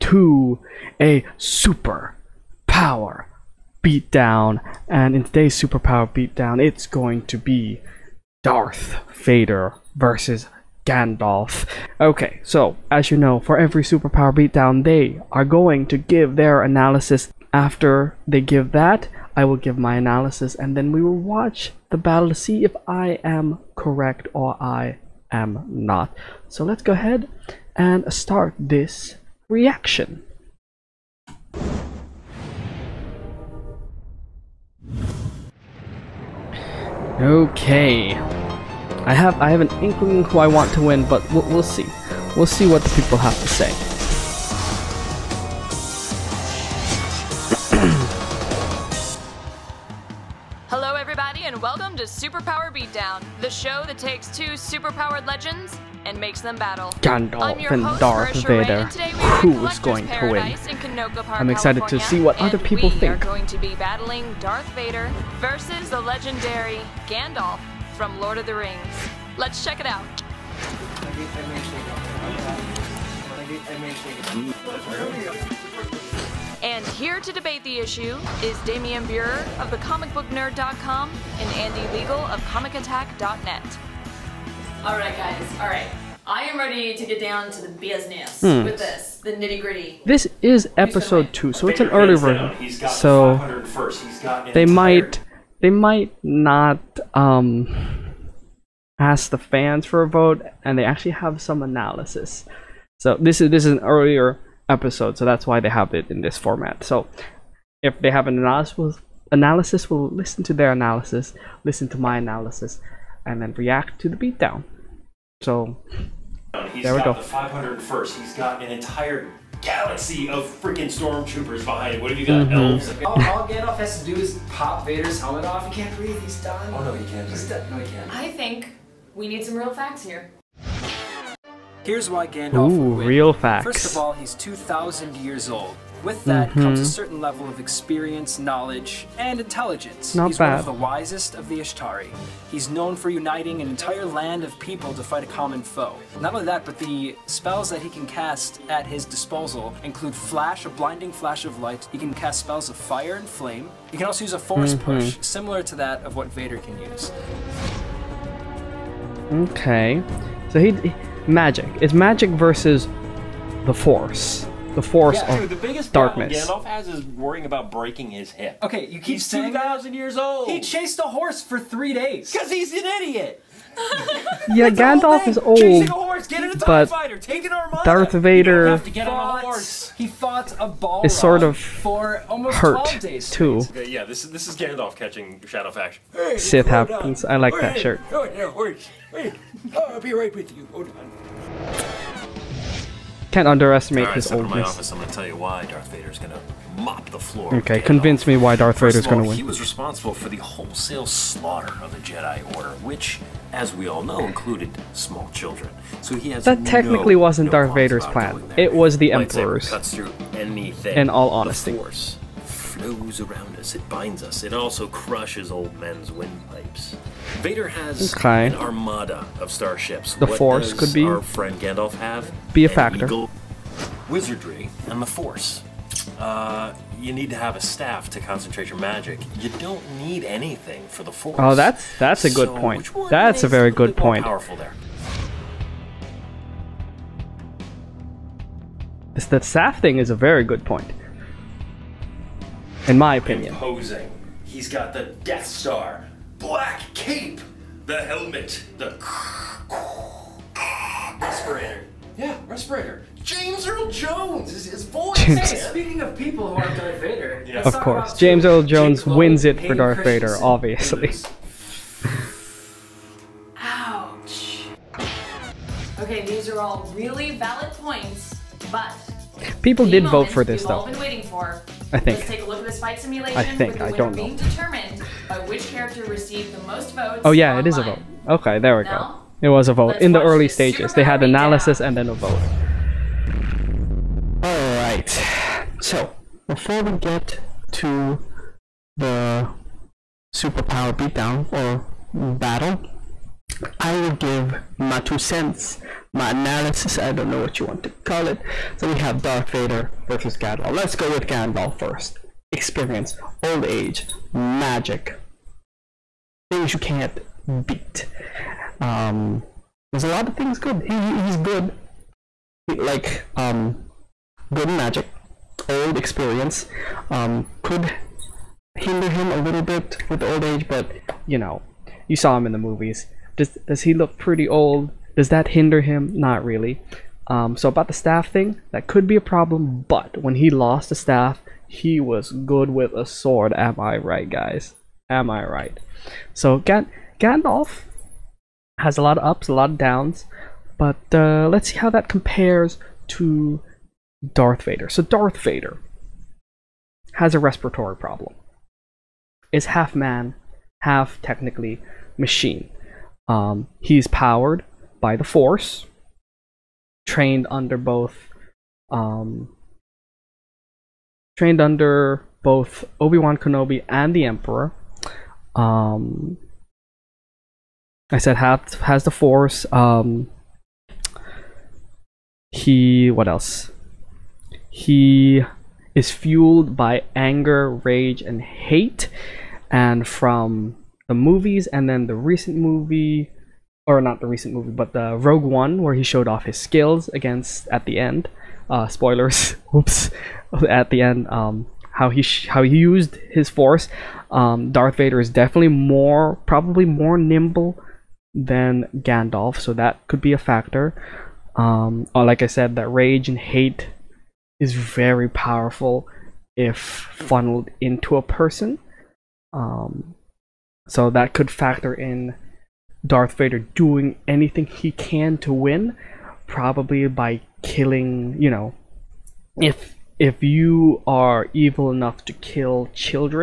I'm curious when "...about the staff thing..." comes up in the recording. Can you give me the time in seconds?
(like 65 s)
327 s.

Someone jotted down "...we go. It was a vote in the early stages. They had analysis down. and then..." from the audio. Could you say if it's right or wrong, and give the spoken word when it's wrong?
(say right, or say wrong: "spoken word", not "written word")
right.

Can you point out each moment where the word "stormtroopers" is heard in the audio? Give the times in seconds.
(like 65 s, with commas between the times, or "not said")
120 s.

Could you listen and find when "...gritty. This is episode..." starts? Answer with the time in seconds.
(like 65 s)
89 s.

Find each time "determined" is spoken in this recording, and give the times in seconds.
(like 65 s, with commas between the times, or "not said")
274 s.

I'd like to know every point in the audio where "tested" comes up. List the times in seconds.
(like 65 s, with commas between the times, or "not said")
not said.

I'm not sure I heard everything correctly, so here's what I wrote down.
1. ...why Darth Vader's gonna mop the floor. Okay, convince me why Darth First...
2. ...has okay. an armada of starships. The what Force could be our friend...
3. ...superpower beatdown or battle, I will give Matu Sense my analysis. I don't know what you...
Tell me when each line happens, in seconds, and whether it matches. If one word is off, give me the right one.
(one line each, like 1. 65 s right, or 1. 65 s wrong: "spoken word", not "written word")
1. 195 s right
2. 217 s right
3. 290 s right.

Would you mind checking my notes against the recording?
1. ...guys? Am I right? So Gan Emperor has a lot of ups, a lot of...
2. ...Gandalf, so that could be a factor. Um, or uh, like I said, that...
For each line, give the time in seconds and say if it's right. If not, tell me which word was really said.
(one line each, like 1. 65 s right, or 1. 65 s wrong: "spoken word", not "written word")
1. 334 s wrong: "Gandalf", not "Emperor"
2. 398 s right.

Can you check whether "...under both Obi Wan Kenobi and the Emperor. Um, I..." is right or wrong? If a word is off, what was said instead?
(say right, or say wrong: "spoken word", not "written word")
right.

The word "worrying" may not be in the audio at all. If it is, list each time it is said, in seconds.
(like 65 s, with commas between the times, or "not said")
167 s.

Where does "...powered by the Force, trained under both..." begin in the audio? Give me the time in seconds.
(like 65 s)
354 s.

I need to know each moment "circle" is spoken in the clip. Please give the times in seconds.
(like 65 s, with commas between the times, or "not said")
not said.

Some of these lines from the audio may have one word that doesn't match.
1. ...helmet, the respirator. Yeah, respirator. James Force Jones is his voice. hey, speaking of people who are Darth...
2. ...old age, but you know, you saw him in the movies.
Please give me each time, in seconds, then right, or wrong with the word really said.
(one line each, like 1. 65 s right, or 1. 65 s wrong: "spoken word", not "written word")
1. 248 s wrong: "Earl", not "Force"
2. 320 s right.